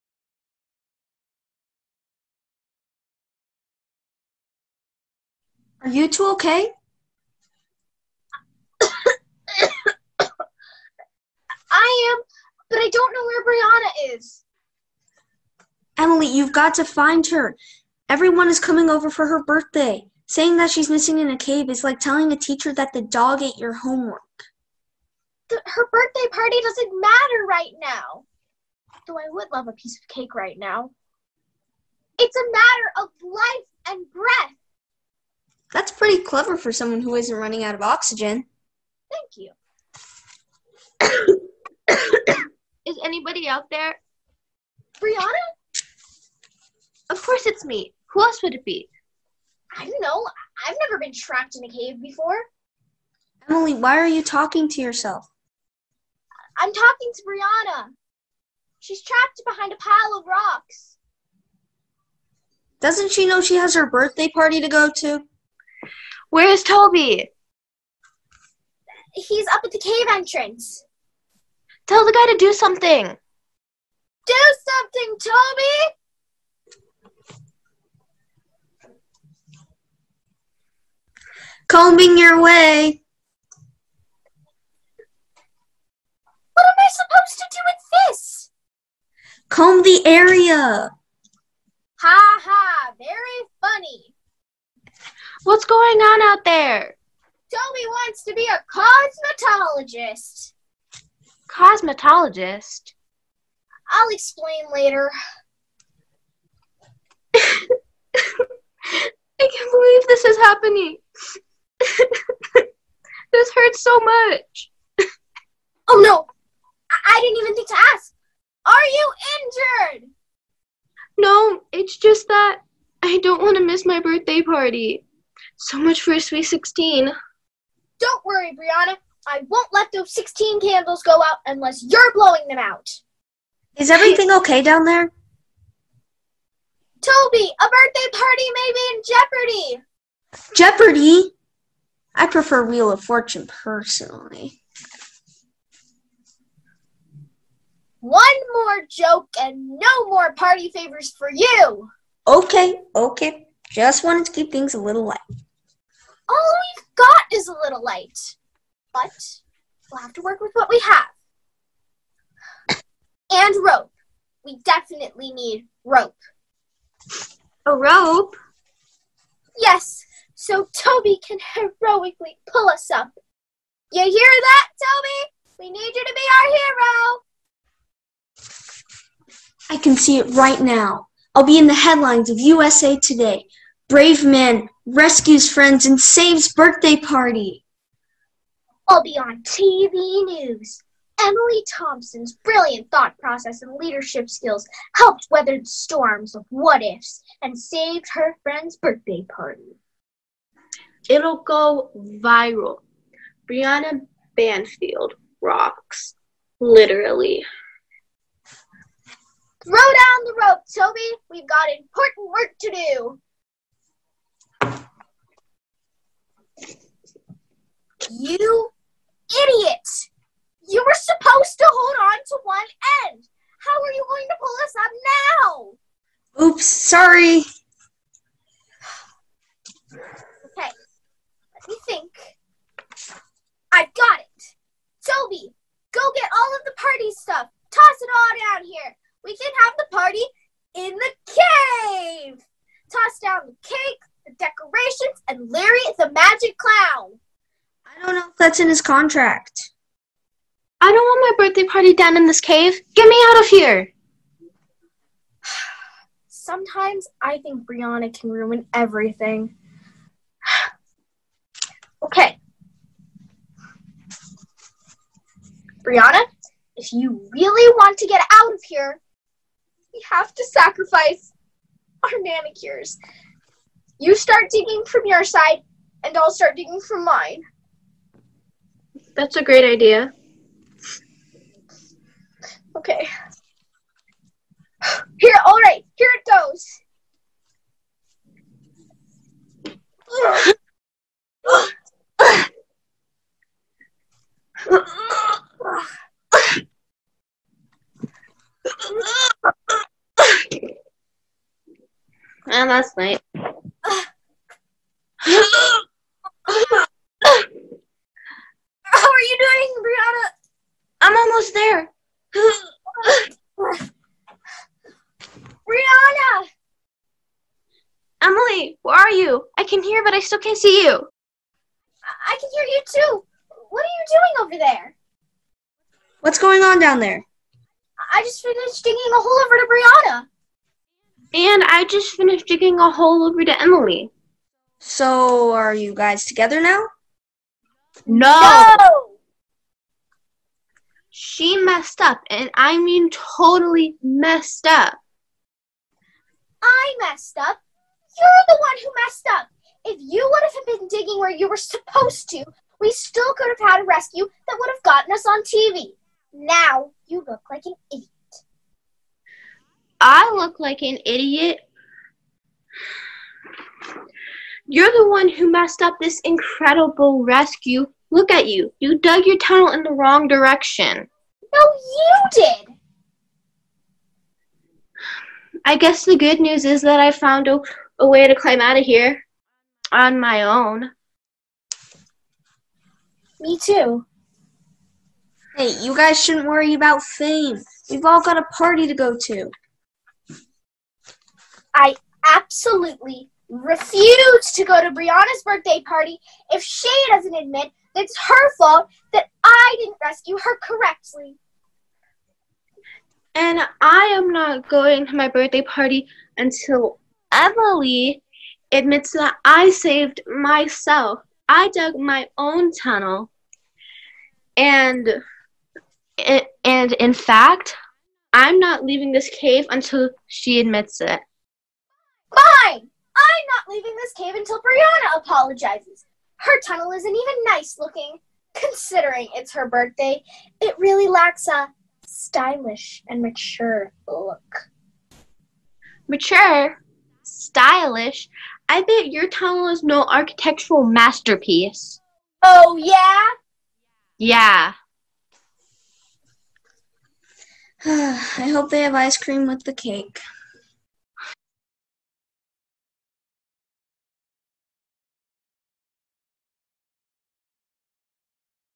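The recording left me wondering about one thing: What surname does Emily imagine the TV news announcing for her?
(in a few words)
Thompson.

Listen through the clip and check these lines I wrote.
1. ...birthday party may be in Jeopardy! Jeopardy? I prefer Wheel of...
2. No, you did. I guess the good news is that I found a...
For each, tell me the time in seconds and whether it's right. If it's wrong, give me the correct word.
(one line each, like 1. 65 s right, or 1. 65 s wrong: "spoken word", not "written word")
1. 137 s right
2. 371 s right.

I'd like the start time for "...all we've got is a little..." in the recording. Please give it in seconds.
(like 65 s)
156 s.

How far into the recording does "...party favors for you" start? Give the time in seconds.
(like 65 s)
150 s.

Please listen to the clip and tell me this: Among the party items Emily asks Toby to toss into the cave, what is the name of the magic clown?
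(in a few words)
Larry.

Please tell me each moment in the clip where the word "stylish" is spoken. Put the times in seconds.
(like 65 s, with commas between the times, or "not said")
432 s, 437 s.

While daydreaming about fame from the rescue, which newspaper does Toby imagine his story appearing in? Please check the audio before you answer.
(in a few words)
USA Today.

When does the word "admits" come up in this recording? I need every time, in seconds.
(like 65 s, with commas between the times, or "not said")
397 s, 408 s, 420 s.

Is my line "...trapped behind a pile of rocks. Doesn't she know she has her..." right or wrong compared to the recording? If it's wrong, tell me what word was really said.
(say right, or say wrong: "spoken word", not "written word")
right.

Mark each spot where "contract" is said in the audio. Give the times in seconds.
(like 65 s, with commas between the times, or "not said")
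248 s.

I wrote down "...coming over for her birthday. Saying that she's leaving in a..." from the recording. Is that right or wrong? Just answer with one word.
wrong.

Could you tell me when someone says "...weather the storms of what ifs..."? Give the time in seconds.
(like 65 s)
195 s.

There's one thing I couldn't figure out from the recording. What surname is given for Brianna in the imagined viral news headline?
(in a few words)
Banfield.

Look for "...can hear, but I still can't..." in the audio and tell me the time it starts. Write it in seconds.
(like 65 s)
319 s.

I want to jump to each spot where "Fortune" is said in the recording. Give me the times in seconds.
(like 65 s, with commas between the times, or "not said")
143 s.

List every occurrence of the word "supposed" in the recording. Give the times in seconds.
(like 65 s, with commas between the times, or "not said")
86 s, 220 s, 351 s.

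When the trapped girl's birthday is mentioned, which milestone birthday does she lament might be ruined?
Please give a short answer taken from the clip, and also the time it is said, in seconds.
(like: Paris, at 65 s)
Sweet 16, at 126 s.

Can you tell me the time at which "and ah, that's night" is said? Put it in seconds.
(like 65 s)
302 s.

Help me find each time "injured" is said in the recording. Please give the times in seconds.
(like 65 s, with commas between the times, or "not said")
119 s.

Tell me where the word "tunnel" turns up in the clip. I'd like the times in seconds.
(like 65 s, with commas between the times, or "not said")
369 s, 412 s, 426 s, 439 s.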